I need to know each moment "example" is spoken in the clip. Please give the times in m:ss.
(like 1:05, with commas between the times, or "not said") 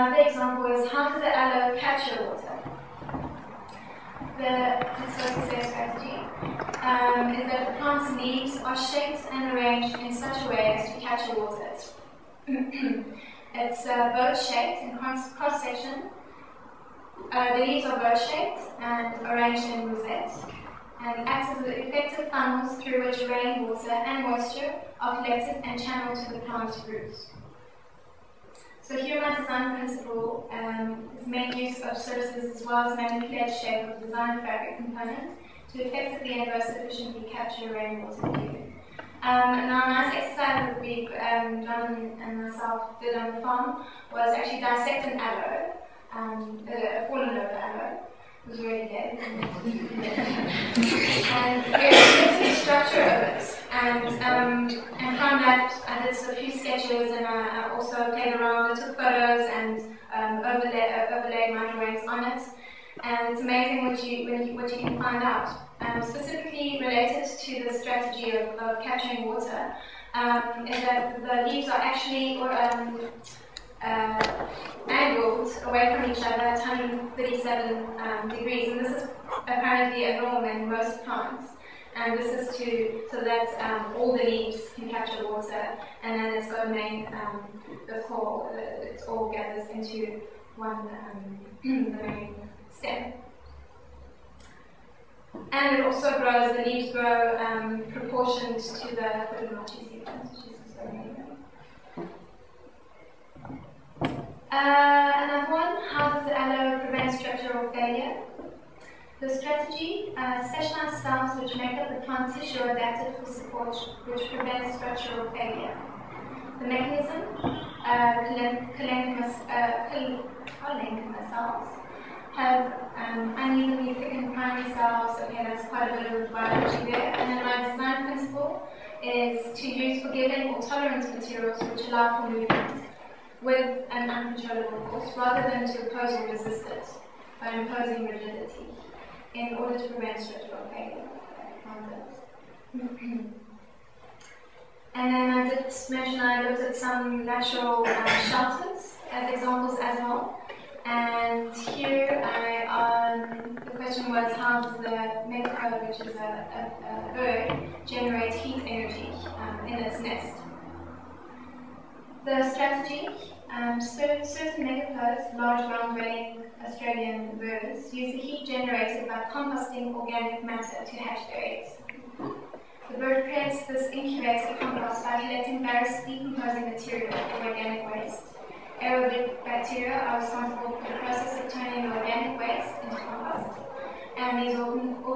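0:00, 2:29.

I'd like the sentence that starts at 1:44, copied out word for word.
Uh, another one, how does the aloe prevent structural failure?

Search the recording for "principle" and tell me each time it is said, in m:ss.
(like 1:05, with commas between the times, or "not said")
0:29, 2:08.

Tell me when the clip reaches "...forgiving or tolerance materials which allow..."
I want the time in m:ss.
2:10.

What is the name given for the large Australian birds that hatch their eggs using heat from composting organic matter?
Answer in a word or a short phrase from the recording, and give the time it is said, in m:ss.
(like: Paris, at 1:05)
megapodes, at 2:44.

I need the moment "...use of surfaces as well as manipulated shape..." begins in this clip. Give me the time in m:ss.
0:31.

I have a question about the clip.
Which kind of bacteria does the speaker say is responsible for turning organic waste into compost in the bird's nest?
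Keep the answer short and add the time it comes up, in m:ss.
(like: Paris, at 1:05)
Aerobic bacteria, at 2:58.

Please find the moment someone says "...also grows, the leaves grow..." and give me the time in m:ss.
1:35.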